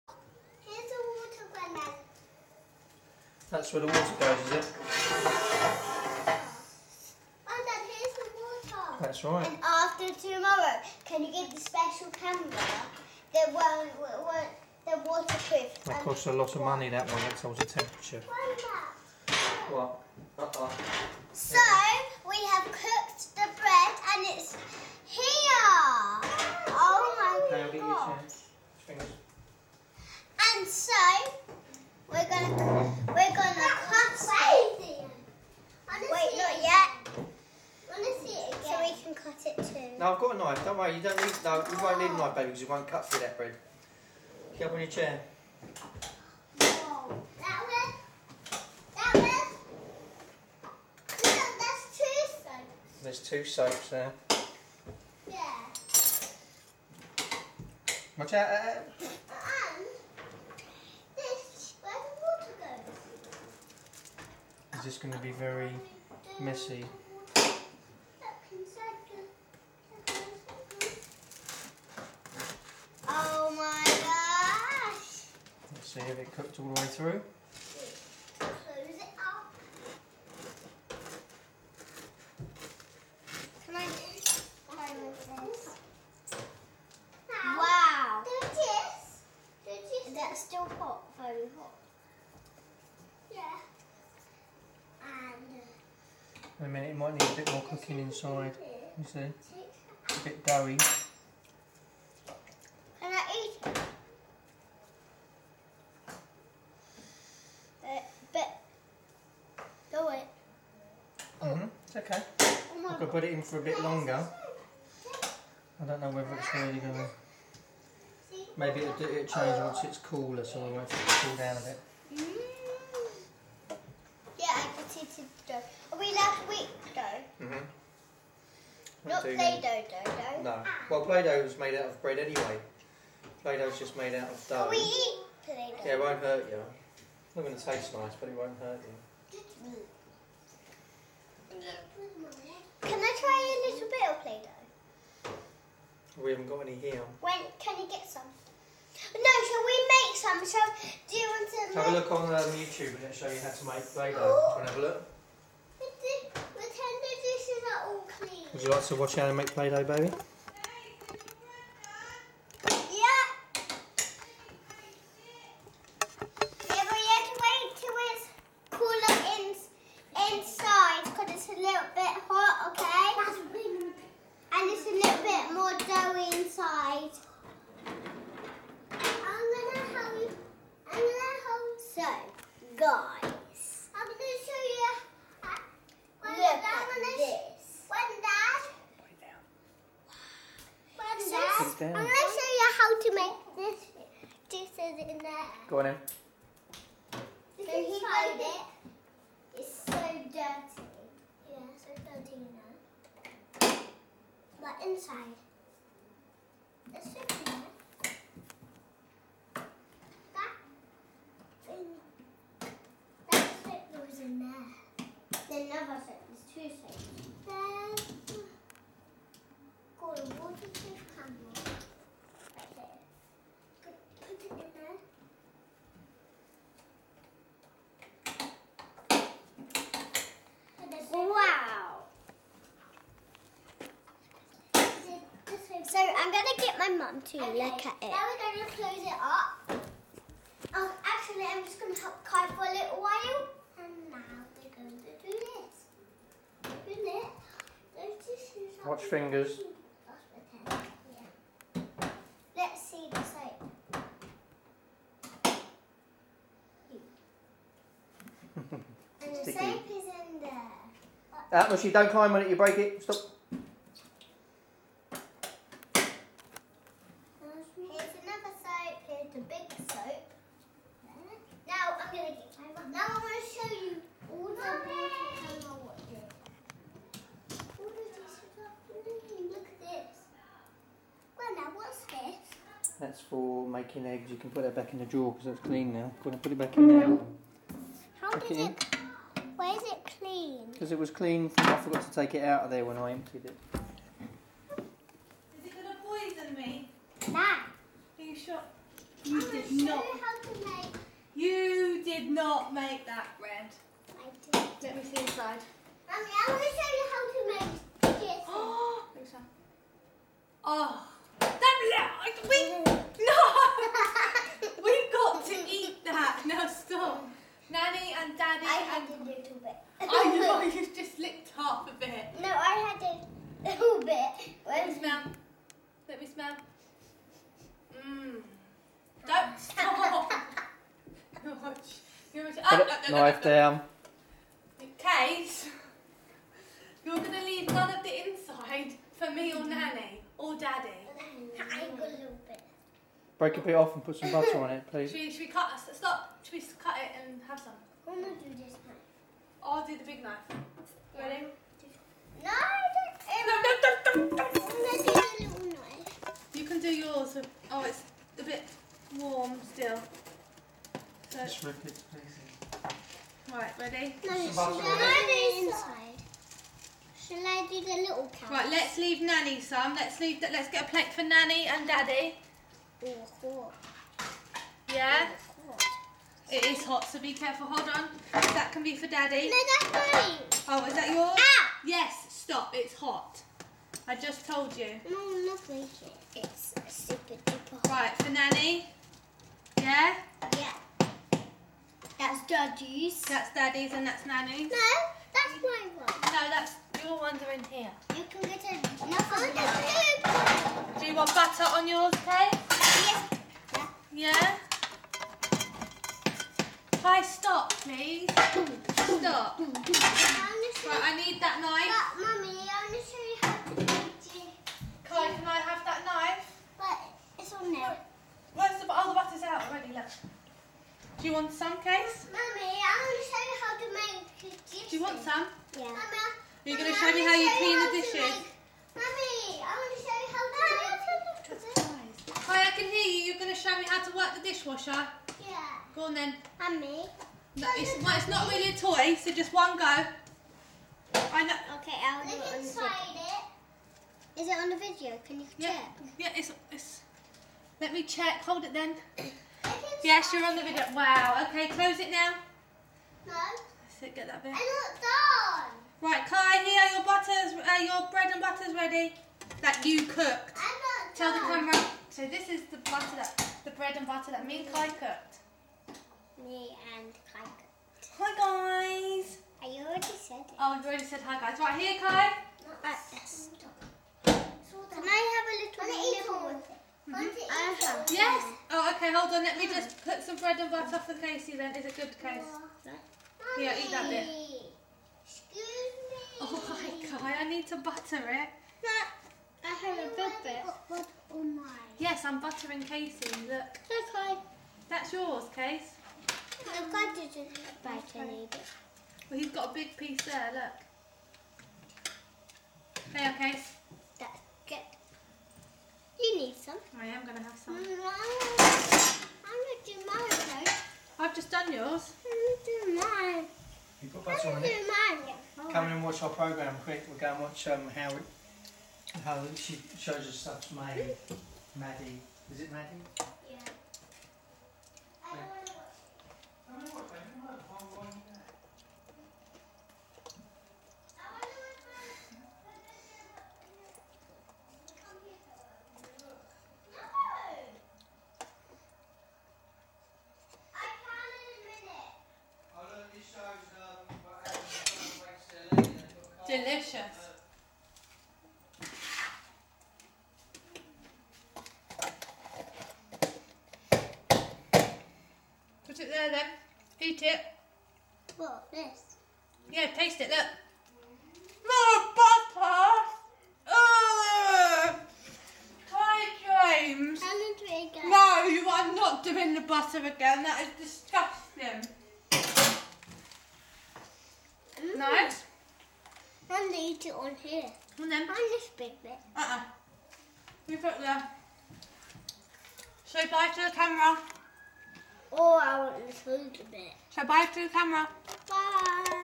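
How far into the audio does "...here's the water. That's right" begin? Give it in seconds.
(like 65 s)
7 s.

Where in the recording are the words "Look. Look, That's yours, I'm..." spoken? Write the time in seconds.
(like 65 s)
493 s.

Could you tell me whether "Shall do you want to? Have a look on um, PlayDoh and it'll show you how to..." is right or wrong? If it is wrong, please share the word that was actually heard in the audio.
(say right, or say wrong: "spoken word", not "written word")
wrong: "YouTube", not "PlayDoh".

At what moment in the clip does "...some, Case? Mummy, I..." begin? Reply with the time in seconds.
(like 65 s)
421 s.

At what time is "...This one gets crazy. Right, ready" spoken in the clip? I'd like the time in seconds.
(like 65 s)
361 s.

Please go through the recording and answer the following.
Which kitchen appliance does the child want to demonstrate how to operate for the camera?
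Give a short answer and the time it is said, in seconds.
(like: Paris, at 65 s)
Dishwasher, at 434 s.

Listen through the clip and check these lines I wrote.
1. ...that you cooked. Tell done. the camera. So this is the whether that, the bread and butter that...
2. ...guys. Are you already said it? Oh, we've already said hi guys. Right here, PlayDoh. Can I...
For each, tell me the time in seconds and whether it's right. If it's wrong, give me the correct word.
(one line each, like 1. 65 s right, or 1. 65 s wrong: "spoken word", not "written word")
1. 459 s wrong: "butter", not "whether"
2. 469 s wrong: "Kai", not "PlayDoh".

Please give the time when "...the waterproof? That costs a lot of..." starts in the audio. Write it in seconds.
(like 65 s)
15 s.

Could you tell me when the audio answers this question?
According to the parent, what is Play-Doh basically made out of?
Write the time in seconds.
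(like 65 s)
133 s.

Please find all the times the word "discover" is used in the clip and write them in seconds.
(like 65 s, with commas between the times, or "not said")
not said.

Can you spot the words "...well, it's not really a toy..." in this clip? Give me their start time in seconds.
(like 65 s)
438 s.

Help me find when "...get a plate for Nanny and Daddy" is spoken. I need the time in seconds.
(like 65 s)
370 s.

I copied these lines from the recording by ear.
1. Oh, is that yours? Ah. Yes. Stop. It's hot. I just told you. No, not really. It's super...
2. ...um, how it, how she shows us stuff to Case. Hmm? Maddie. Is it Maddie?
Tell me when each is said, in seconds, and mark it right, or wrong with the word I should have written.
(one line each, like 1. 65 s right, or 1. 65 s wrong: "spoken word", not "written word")
1. 380 s right
2. 517 s wrong: "Maddie", not "Case".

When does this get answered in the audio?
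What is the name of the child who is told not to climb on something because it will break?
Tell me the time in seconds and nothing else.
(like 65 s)
261 s.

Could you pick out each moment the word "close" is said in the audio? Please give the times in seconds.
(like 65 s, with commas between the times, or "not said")
238 s, 451 s.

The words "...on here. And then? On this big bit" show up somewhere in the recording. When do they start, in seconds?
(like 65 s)
577 s.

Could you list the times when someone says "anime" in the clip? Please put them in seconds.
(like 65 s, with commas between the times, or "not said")
159 s.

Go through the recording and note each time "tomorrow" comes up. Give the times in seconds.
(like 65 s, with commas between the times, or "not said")
10 s.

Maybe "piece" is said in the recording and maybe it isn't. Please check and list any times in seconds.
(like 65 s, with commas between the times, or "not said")
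499 s.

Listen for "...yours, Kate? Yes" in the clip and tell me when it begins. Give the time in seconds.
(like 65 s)
401 s.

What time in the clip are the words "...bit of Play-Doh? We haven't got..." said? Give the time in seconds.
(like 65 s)
143 s.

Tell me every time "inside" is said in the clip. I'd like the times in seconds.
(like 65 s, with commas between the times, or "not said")
97 s, 204 s, 305 s, 338 s, 365 s, 442 s.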